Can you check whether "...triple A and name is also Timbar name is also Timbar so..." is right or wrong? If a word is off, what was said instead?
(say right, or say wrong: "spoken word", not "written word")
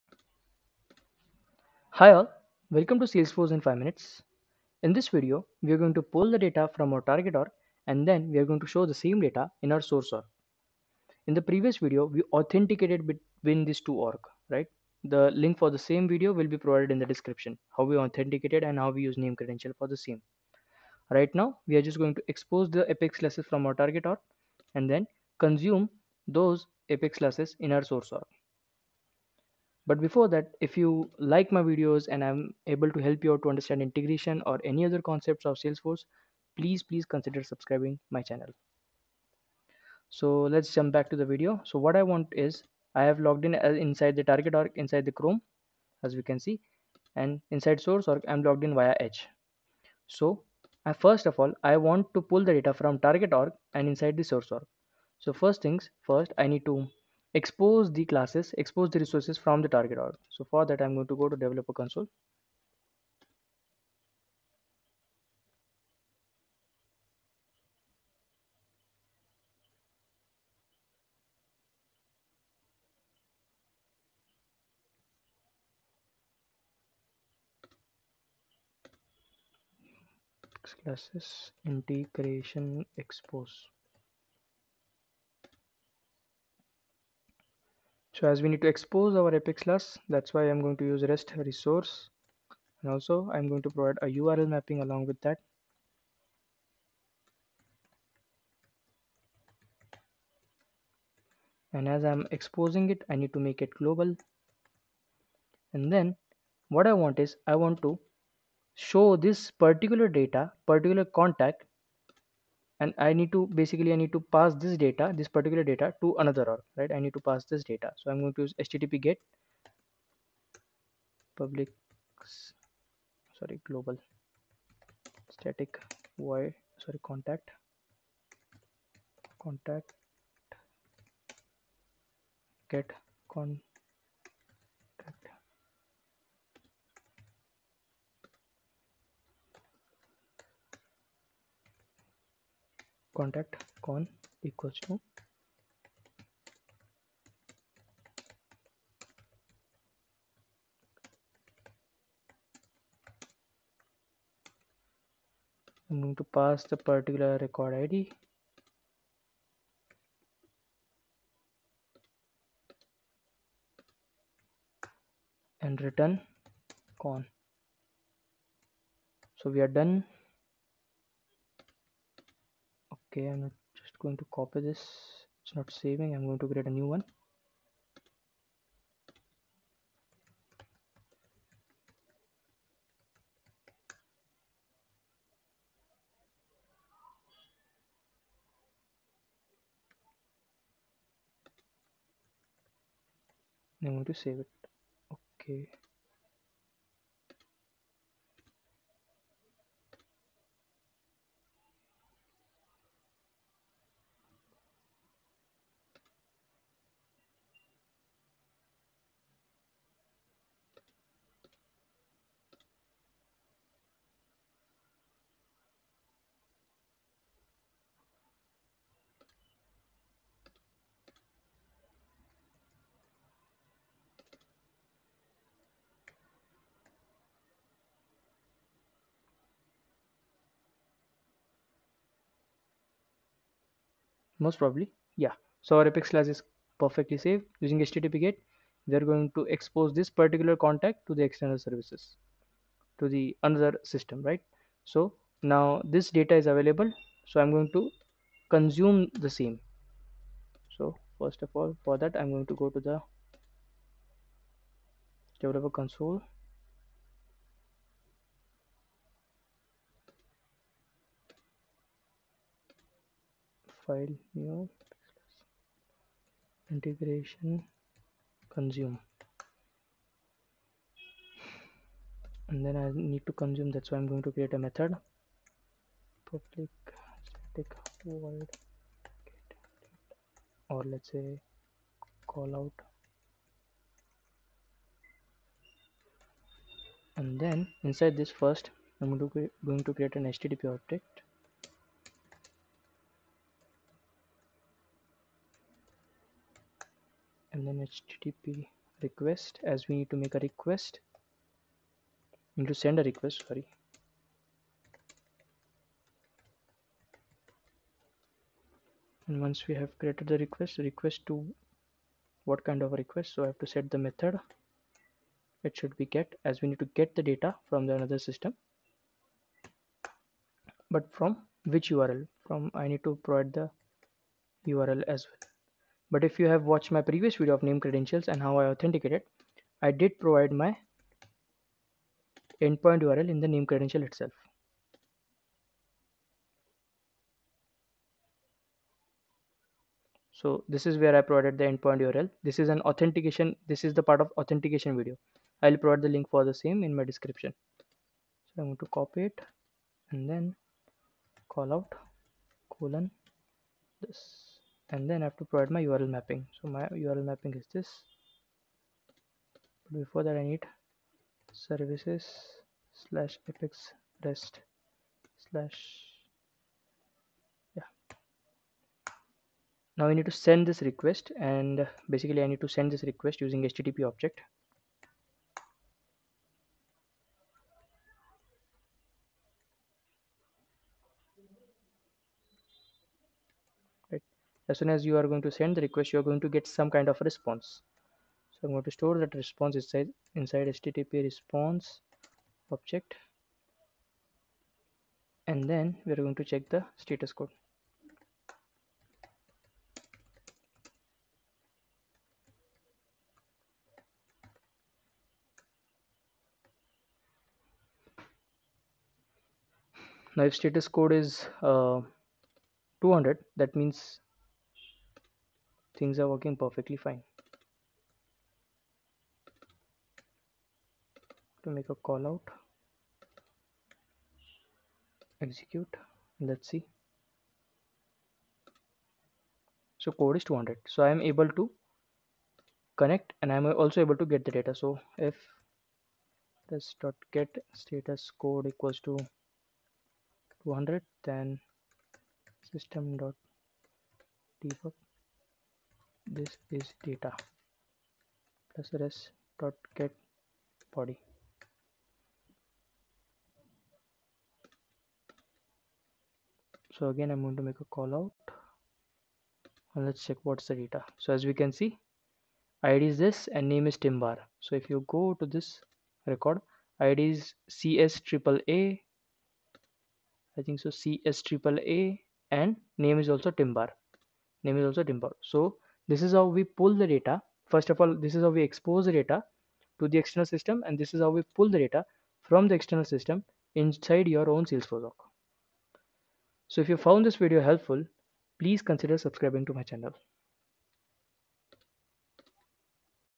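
right.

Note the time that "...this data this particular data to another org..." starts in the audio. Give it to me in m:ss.
1:54.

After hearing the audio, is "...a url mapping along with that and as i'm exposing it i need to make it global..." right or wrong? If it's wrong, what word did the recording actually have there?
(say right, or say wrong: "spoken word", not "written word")
right.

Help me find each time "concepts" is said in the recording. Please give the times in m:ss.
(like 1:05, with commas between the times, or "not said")
0:35.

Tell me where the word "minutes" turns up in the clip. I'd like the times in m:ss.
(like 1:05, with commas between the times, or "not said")
0:03.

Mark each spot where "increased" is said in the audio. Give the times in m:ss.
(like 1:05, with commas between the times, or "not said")
not said.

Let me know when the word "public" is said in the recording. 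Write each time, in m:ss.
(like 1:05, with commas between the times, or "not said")
2:01, 4:36.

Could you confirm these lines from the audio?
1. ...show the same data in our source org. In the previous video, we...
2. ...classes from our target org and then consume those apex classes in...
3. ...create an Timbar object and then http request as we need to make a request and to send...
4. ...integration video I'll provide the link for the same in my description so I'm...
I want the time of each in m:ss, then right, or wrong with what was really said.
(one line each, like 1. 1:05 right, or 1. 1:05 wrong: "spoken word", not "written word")
1. 0:08 right
2. 0:23 right
3. 4:49 wrong: "HTTP", not "Timbar"
4. 5:44 wrong: "authentication", not "integration".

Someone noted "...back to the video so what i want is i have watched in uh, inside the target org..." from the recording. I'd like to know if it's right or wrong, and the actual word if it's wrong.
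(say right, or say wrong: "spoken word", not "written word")
wrong: "logged", not "watched".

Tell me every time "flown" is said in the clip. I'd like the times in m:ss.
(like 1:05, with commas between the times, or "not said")
not said.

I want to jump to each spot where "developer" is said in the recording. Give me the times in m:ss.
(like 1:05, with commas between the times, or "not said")
1:01, 4:15.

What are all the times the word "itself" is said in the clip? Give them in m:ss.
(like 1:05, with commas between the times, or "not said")
5:34.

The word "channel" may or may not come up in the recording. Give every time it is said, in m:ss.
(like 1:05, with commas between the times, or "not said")
0:38, 8:09.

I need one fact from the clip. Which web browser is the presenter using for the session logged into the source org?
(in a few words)
Edge.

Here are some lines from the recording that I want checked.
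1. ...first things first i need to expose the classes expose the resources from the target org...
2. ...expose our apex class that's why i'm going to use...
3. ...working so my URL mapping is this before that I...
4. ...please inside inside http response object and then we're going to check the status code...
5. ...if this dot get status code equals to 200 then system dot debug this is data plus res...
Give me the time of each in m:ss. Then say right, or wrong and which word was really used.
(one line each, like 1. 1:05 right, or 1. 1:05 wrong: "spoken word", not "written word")
1. 0:55 right
2. 1:28 right
3. 5:56 wrong: "mapping", not "working"
4. 6:29 wrong: "response", not "please"
5. 7:15 right.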